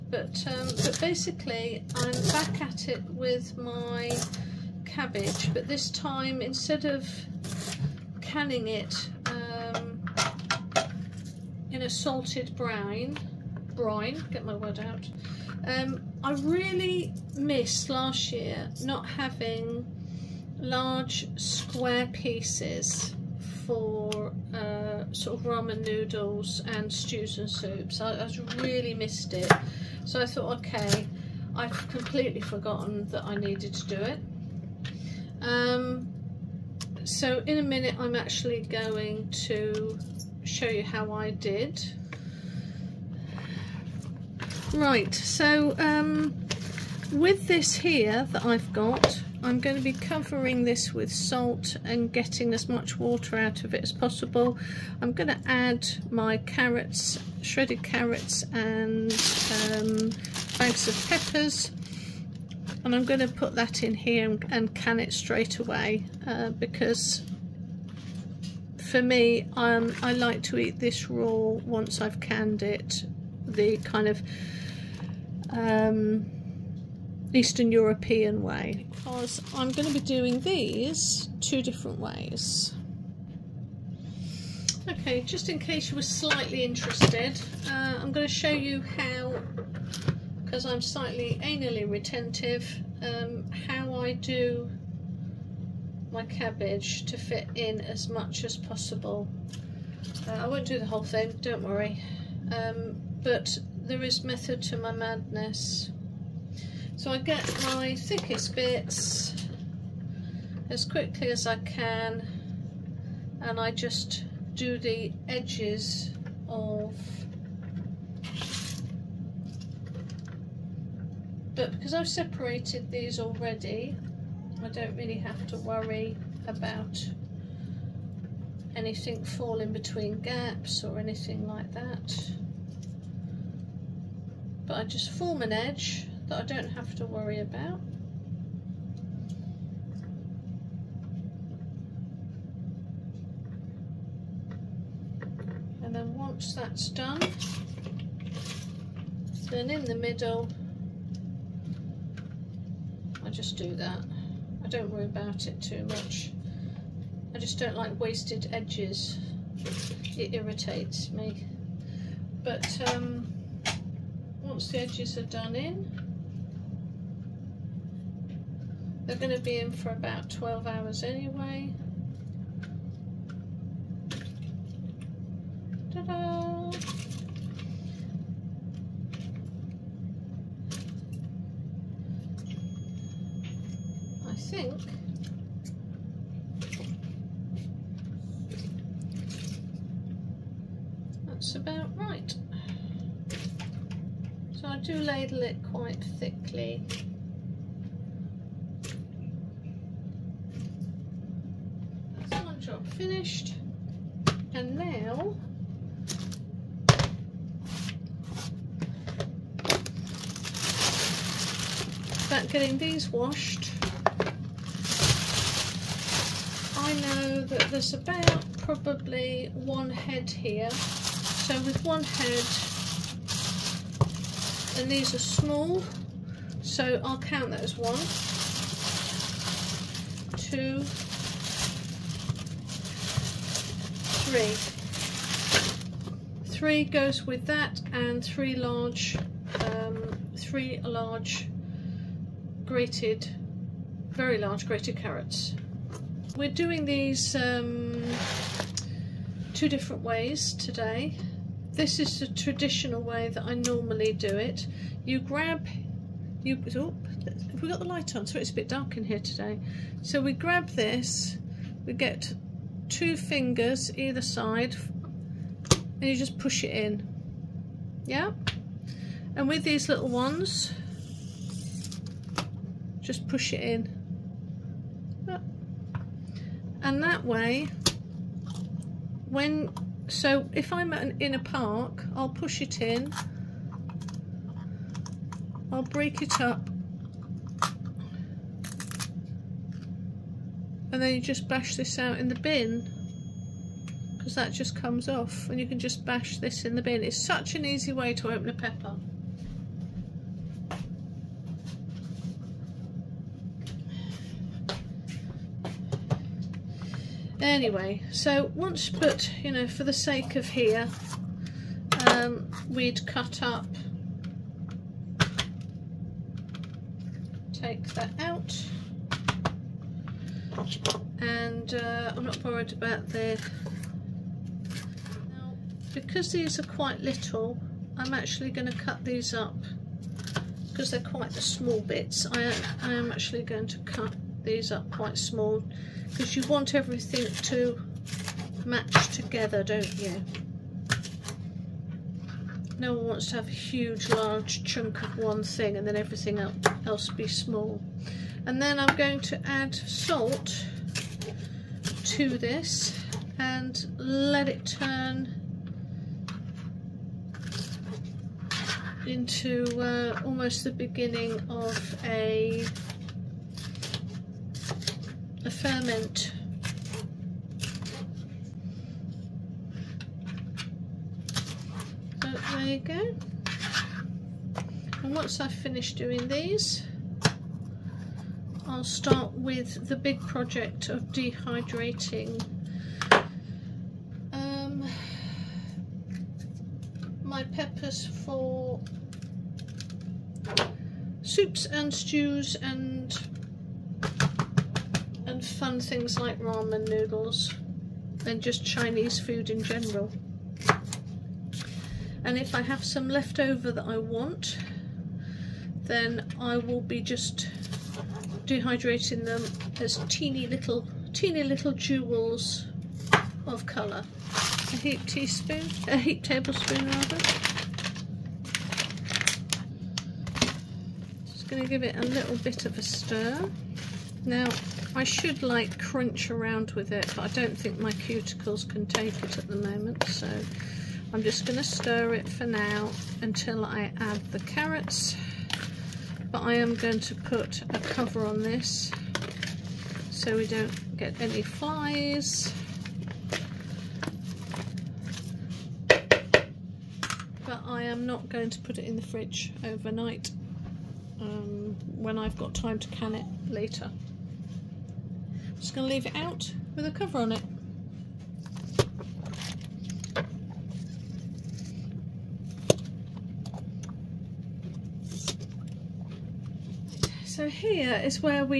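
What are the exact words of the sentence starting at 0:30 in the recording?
So I thought, okay, I've completely forgotten that I needed to do it.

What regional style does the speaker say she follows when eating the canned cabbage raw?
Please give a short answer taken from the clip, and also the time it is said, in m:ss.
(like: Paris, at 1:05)
Eastern European, at 1:17.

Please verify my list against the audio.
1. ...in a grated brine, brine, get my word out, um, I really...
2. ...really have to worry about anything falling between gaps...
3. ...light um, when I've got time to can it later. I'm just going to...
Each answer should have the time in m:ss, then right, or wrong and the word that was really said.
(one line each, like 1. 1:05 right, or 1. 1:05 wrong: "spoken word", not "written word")
1. 0:11 wrong: "salted", not "grated"
2. 2:04 right
3. 7:29 wrong: "overnight", not "light".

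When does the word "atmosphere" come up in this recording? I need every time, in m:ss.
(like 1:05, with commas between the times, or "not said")
not said.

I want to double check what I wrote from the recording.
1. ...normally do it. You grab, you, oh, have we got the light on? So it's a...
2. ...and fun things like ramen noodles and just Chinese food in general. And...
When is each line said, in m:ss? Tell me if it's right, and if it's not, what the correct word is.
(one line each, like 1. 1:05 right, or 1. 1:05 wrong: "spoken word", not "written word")
1. 4:13 right
2. 6:35 right.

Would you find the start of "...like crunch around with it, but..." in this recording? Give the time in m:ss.
7:05.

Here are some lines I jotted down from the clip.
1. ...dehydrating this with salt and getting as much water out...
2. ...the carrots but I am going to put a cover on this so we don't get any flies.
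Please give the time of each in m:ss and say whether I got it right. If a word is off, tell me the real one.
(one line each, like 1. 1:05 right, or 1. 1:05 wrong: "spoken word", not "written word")
1. 0:49 wrong: "covering", not "dehydrating"
2. 7:14 right.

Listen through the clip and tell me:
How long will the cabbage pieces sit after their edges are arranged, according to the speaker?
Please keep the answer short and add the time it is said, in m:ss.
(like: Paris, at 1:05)
12 hours, at 2:49.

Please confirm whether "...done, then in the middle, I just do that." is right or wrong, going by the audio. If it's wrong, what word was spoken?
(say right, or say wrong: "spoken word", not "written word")
right.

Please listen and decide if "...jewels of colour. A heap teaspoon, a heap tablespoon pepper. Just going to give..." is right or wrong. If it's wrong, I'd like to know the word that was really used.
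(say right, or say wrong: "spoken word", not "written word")
wrong: "rather", not "pepper".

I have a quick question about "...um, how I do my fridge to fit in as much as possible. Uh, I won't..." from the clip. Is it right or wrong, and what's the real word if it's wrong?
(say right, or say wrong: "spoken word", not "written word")
wrong: "cabbage", not "fridge".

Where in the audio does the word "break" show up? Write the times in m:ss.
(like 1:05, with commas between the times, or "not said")
4:45.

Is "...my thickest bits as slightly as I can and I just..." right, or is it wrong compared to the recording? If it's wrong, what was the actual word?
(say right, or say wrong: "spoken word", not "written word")
wrong: "quickly", not "slightly".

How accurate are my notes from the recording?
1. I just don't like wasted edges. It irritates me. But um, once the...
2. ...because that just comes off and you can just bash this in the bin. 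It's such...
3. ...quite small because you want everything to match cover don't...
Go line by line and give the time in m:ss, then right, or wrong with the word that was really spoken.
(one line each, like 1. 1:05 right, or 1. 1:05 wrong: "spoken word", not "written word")
1. 2:37 right
2. 4:54 right
3. 5:34 wrong: "together", not "cover".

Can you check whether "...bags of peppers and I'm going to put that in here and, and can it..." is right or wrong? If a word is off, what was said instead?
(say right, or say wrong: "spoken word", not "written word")
right.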